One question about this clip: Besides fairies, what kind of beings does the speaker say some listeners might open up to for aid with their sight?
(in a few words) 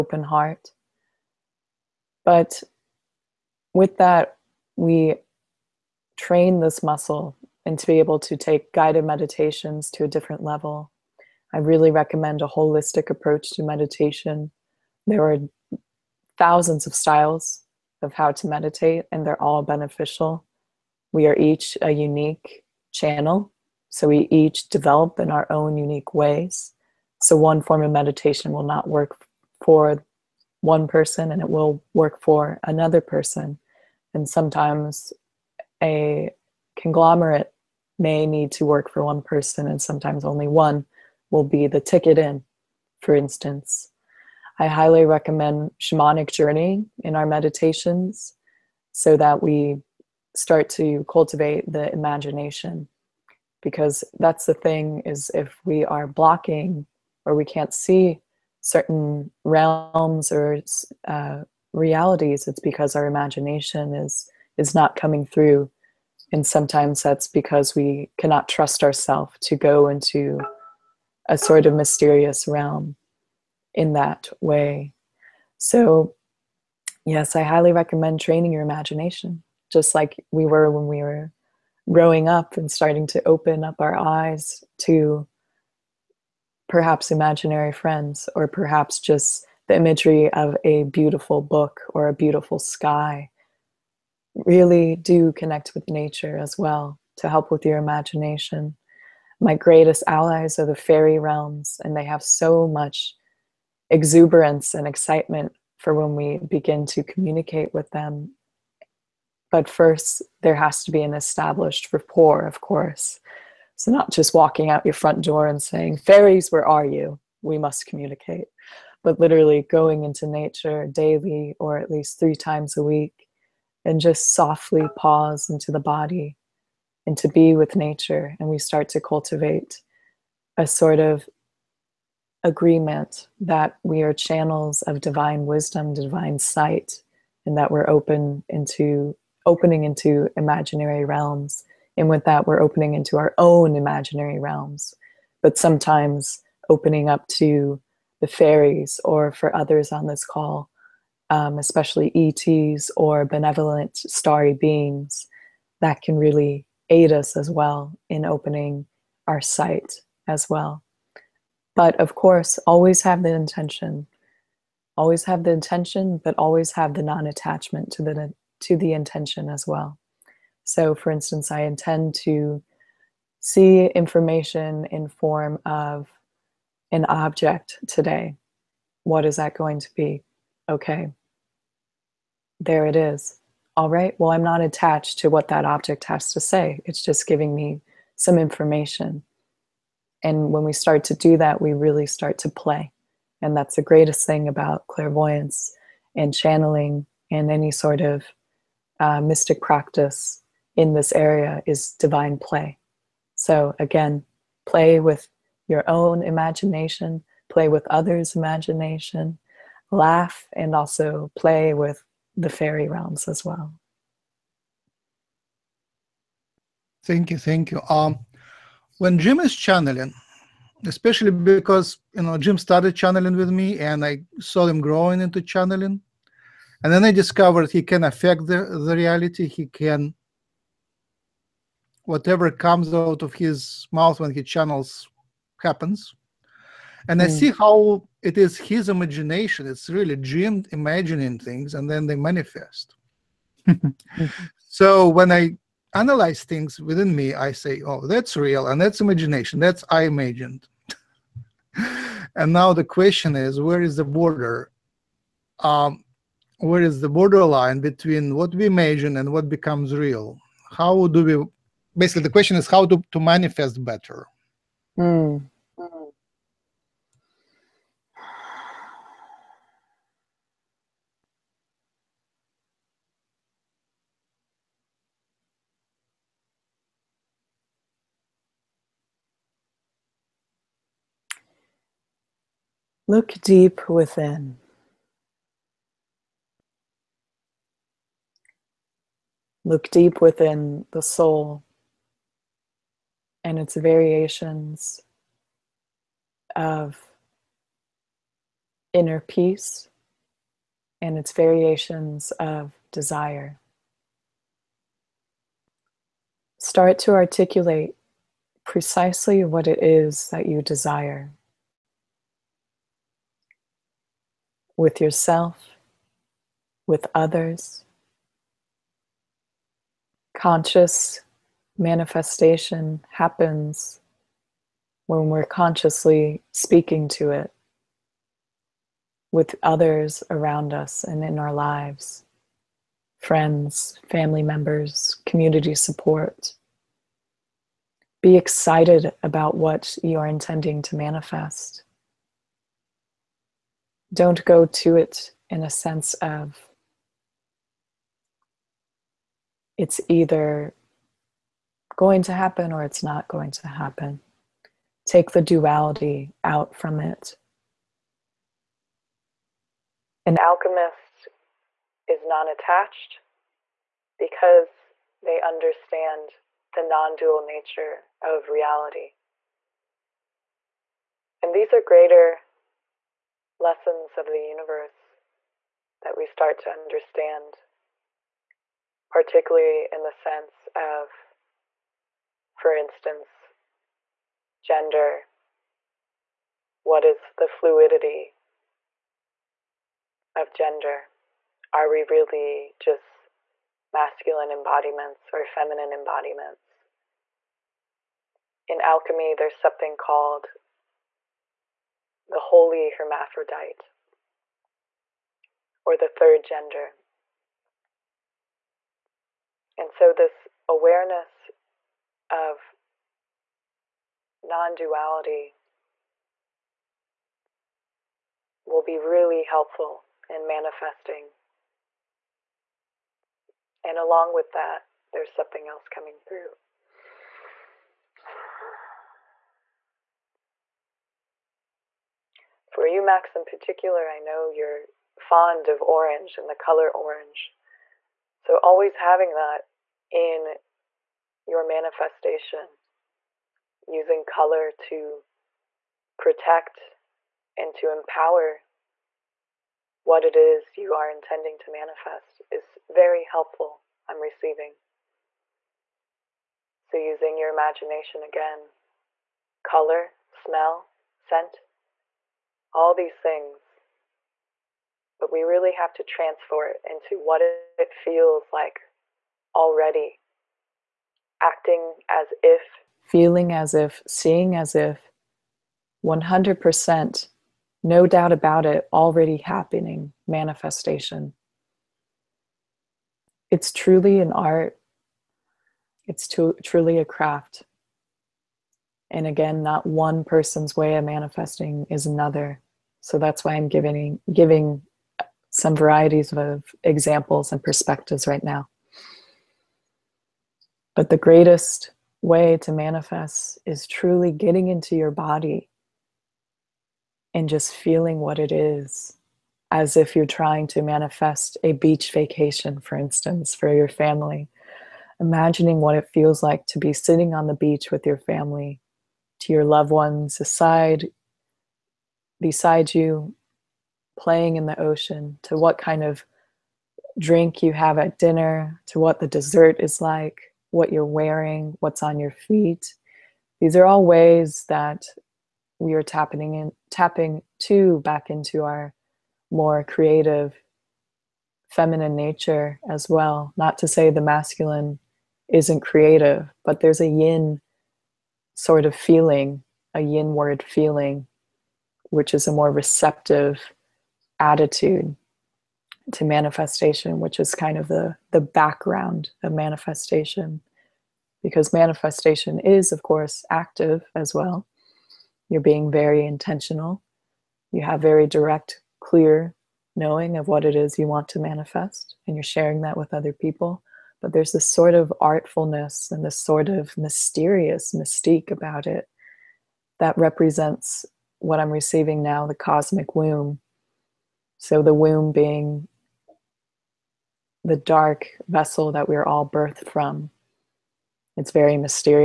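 ETs.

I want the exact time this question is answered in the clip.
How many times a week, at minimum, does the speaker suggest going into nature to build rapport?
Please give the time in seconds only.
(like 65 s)
122 s.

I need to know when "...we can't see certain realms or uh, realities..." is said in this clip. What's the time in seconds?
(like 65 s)
57 s.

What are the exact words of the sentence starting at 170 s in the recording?
So, for instance, I intend to see information in form of an object today.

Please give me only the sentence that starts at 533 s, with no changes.
These are all ways that we are tapping in, tapping to back into our more creative feminine nature as well.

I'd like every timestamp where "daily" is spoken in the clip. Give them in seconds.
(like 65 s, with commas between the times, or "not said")
120 s.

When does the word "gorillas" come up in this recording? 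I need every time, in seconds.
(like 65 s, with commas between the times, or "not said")
not said.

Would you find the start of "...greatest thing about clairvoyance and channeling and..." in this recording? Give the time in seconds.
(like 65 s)
193 s.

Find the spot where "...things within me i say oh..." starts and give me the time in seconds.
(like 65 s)
246 s.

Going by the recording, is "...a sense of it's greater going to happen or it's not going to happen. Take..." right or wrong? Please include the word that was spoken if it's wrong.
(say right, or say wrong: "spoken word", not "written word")
wrong: "either", not "greater".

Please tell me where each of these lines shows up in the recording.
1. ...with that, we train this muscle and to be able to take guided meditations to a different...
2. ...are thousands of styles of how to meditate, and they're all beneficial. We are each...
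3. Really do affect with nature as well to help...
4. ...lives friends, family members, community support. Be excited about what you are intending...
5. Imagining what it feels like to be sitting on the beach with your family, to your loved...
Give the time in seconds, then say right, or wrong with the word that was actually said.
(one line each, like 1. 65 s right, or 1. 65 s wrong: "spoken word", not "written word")
1. 3 s right
2. 15 s right
3. 94 s wrong: "connect", not "affect"
4. 331 s right
5. 515 s right.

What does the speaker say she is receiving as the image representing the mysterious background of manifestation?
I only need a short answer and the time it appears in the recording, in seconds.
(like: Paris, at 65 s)
cosmic womb, at 582 s.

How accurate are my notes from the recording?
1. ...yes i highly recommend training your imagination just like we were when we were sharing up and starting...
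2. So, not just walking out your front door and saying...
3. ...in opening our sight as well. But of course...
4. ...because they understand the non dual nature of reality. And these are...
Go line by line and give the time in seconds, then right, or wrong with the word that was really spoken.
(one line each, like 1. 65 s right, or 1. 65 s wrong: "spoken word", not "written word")
1. 77 s wrong: "growing", not "sharing"
2. 113 s right
3. 158 s right
4. 364 s right.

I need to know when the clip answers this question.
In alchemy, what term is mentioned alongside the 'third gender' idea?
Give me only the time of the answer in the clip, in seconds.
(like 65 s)
402 s.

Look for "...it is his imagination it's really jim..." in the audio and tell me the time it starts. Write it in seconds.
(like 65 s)
238 s.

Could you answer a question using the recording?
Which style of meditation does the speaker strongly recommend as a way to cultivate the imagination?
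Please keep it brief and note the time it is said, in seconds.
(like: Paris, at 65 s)
shamanic journey, at 45 s.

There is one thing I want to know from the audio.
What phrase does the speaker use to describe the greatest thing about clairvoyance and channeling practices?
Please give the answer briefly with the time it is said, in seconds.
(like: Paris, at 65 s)
divine play, at 201 s.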